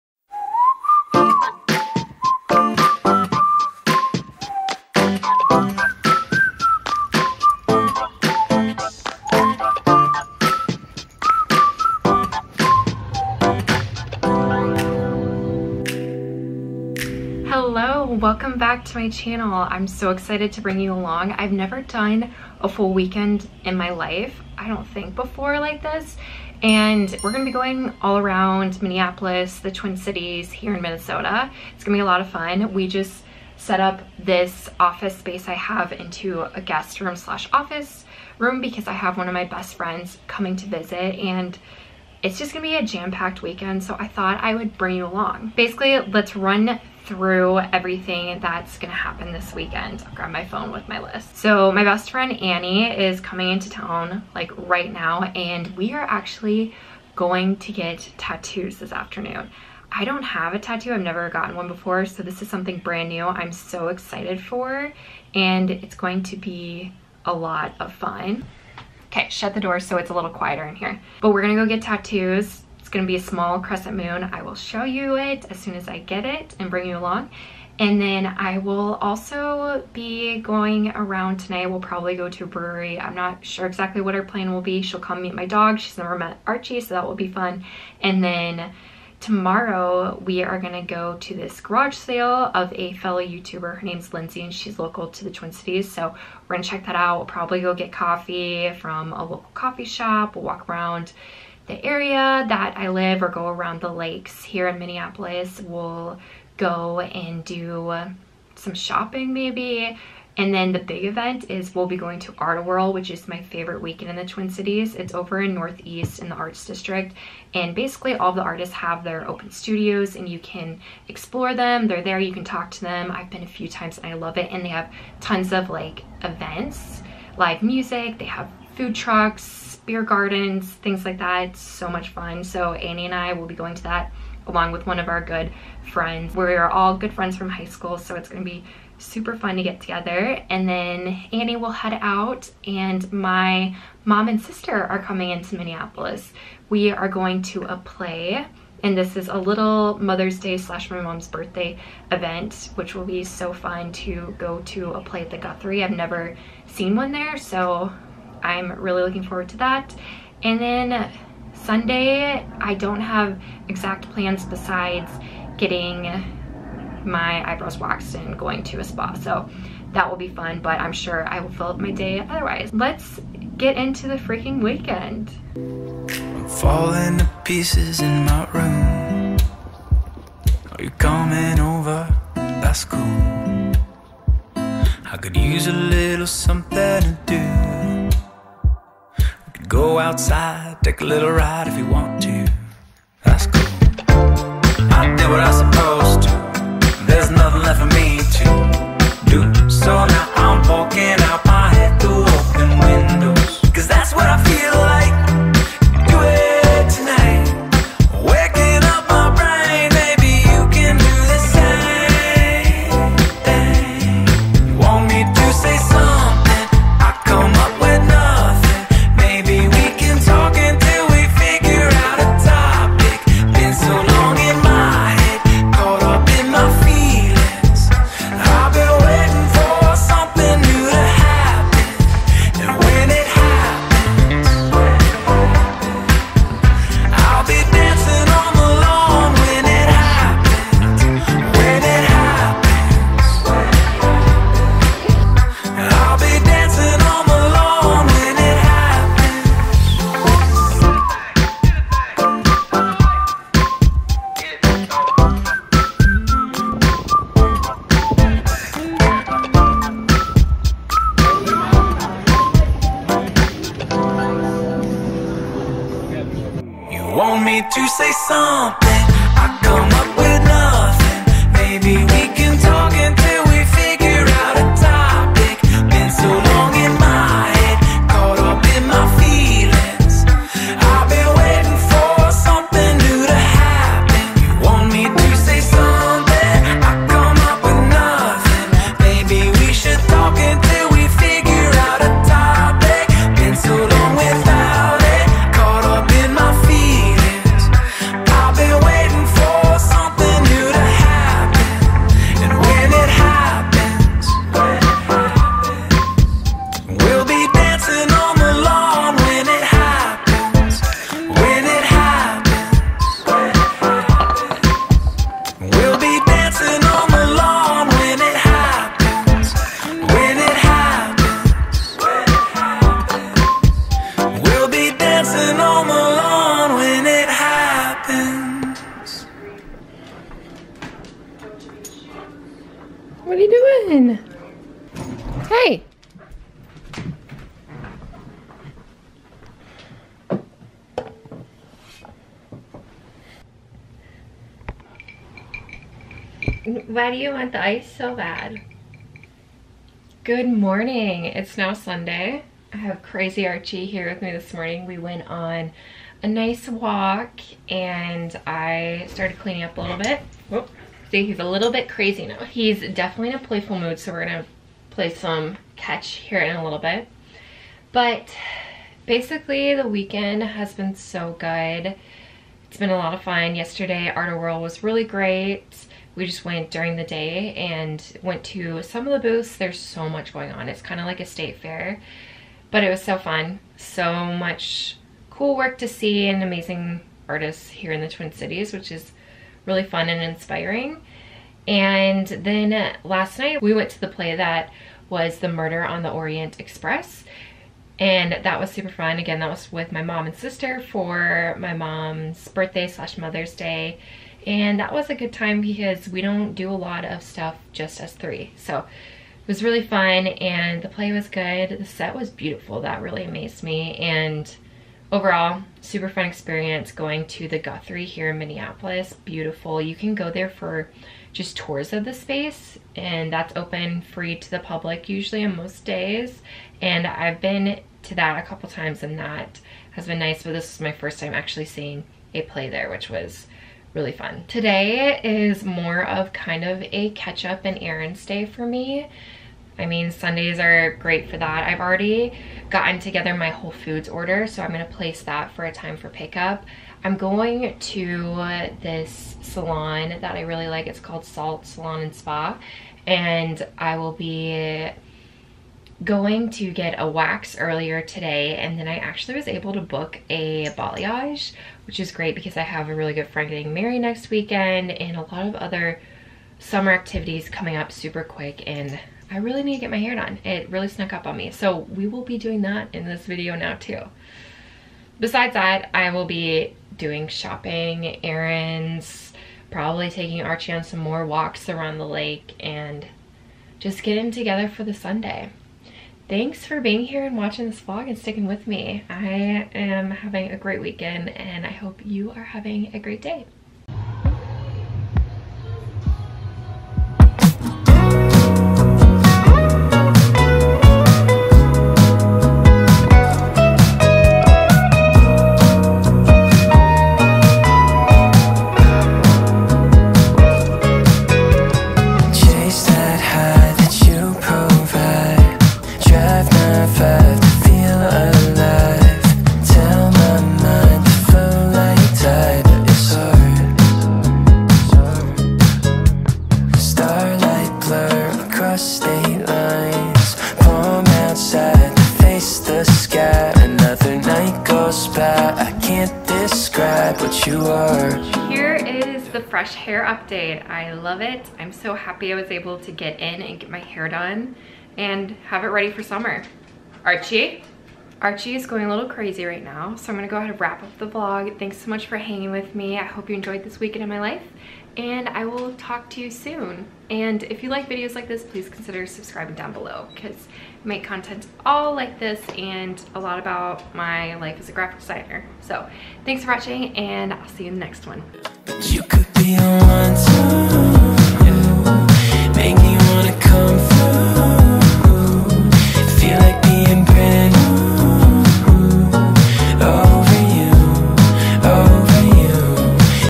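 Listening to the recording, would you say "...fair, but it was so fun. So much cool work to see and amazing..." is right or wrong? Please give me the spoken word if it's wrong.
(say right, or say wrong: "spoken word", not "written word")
right.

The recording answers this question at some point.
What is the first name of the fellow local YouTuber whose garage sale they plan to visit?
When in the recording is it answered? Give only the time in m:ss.
1:34.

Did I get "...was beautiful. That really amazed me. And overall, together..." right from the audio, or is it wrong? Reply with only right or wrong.
wrong.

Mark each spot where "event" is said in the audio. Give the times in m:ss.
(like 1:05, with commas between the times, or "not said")
1:51, 2:06, 2:32.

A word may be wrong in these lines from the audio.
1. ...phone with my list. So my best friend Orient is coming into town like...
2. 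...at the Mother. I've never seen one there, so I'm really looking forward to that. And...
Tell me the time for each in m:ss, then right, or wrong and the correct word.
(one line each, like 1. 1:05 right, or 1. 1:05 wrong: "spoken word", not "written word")
1. 0:50 wrong: "Annie", not "Orient"
2. 2:35 wrong: "Guthrie", not "Mother".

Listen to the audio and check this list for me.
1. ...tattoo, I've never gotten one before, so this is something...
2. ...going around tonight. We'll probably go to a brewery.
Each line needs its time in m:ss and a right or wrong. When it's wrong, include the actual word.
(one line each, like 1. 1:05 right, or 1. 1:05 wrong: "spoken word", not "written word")
1. 1:00 right
2. 1:20 right.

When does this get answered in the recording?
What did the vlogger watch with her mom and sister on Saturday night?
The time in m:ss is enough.
6:35.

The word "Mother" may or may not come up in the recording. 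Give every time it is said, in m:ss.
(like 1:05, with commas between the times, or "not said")
2:29, 6:43.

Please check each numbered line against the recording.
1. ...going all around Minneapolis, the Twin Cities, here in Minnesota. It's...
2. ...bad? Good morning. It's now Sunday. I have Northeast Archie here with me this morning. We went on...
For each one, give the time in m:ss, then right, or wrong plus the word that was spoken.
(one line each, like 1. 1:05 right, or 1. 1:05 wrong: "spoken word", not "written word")
1. 0:27 right
2. 5:48 wrong: "Crazy", not "Northeast".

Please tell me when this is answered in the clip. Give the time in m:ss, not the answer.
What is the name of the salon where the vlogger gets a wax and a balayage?
7:31.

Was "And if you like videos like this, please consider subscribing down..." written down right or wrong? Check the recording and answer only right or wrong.
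right.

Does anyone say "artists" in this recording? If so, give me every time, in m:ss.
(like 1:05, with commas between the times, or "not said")
1:58, 6:27.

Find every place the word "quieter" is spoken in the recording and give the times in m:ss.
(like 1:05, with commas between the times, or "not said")
1:10.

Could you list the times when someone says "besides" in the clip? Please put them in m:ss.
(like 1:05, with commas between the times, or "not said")
2:44, 7:55.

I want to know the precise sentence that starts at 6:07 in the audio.
But basically, the weekend has been so good.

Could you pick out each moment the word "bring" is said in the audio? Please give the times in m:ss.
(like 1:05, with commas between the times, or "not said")
0:20, 0:44, 1:16.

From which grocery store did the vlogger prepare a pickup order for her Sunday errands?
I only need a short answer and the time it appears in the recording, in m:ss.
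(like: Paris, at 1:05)
Whole Foods, at 7:23.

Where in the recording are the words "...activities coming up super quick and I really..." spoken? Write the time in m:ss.
7:46.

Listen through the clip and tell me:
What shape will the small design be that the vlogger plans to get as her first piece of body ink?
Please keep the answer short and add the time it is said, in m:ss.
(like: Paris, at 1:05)
Crescent moon, at 1:13.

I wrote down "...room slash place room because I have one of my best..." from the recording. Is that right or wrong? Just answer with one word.
wrong.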